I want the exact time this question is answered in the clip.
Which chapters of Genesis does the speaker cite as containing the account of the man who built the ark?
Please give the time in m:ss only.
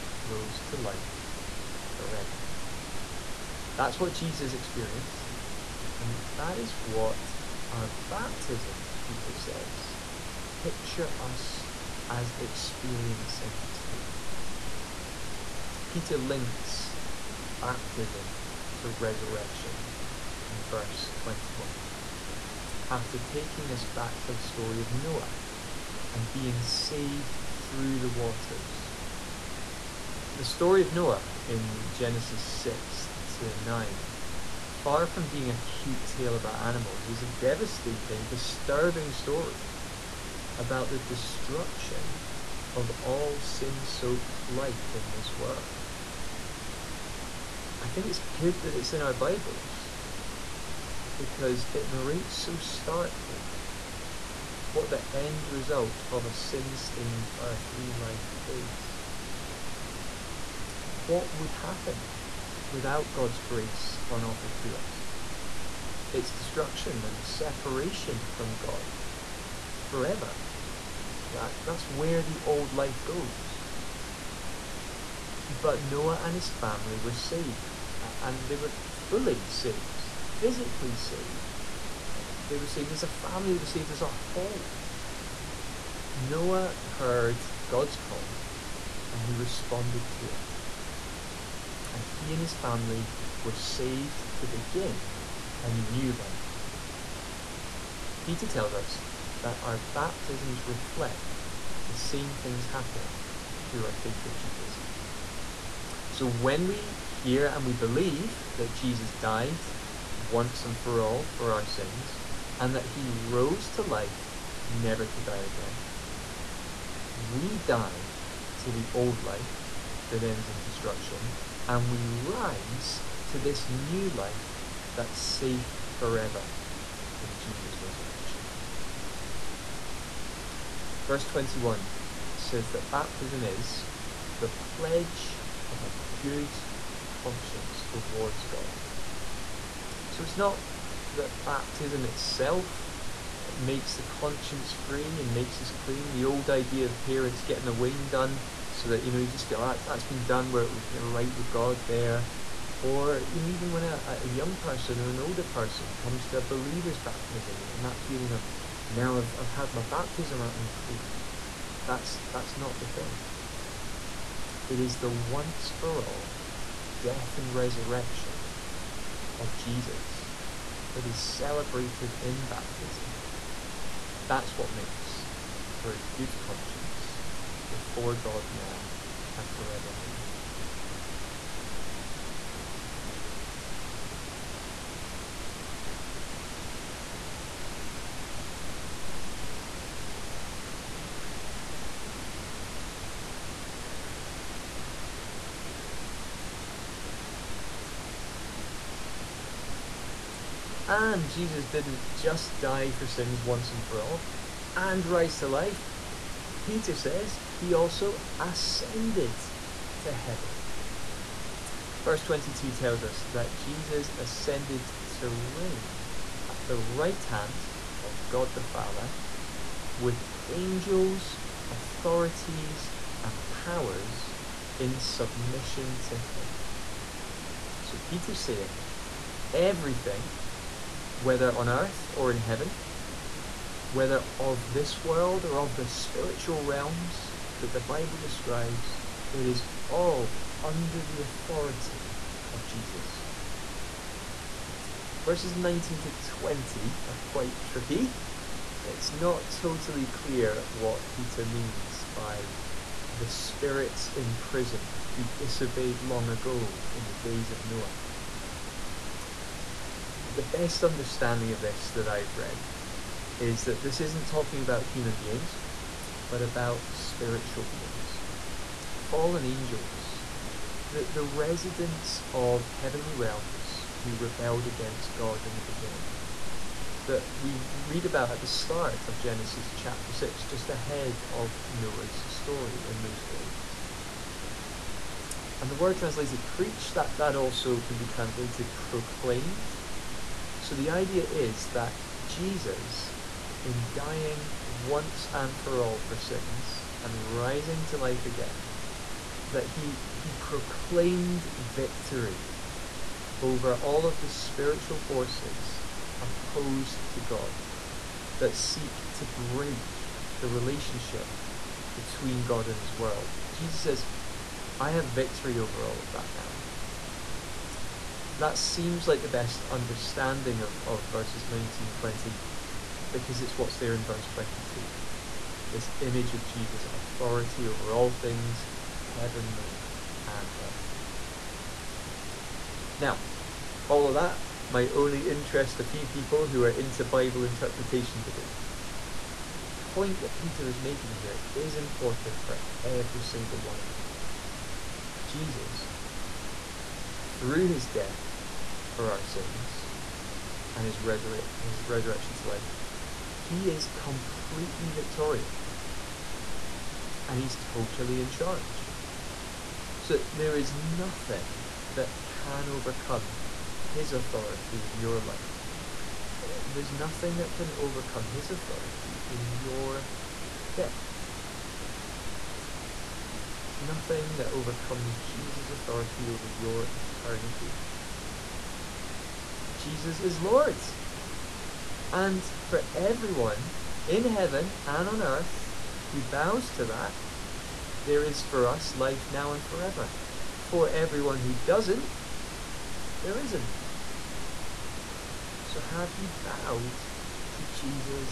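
0:31.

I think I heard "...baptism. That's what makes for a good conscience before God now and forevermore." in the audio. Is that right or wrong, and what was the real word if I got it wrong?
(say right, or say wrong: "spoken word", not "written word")
right.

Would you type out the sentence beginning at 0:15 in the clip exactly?
Peter links baptism to resurrection in verse 21.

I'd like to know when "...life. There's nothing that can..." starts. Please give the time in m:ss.
6:05.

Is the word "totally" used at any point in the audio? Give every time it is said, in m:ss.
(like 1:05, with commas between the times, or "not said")
4:09, 5:57.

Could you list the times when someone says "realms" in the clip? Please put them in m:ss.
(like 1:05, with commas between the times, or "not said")
3:56, 4:33.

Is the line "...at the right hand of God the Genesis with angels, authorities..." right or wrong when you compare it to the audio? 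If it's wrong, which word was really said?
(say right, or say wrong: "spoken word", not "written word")
wrong: "Father", not "Genesis".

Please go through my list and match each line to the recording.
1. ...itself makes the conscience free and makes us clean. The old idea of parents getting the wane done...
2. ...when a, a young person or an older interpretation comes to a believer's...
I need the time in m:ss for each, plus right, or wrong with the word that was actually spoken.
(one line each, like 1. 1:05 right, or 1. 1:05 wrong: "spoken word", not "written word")
1. 2:22 right
2. 2:33 wrong: "person", not "interpretation".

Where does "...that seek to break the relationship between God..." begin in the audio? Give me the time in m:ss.
5:08.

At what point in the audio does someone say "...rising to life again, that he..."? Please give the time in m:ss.
4:57.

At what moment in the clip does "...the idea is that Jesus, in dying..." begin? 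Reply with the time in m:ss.
4:50.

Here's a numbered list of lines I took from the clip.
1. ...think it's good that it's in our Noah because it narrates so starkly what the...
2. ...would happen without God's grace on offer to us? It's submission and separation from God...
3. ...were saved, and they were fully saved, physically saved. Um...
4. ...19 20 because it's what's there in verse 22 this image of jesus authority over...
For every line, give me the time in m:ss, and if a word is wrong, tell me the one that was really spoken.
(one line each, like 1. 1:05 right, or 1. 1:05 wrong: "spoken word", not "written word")
1. 0:47 wrong: "Bibles", not "Noah"
2. 1:01 wrong: "destruction", not "submission"
3. 1:16 right
4. 5:21 right.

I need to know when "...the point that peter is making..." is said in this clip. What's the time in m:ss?
5:39.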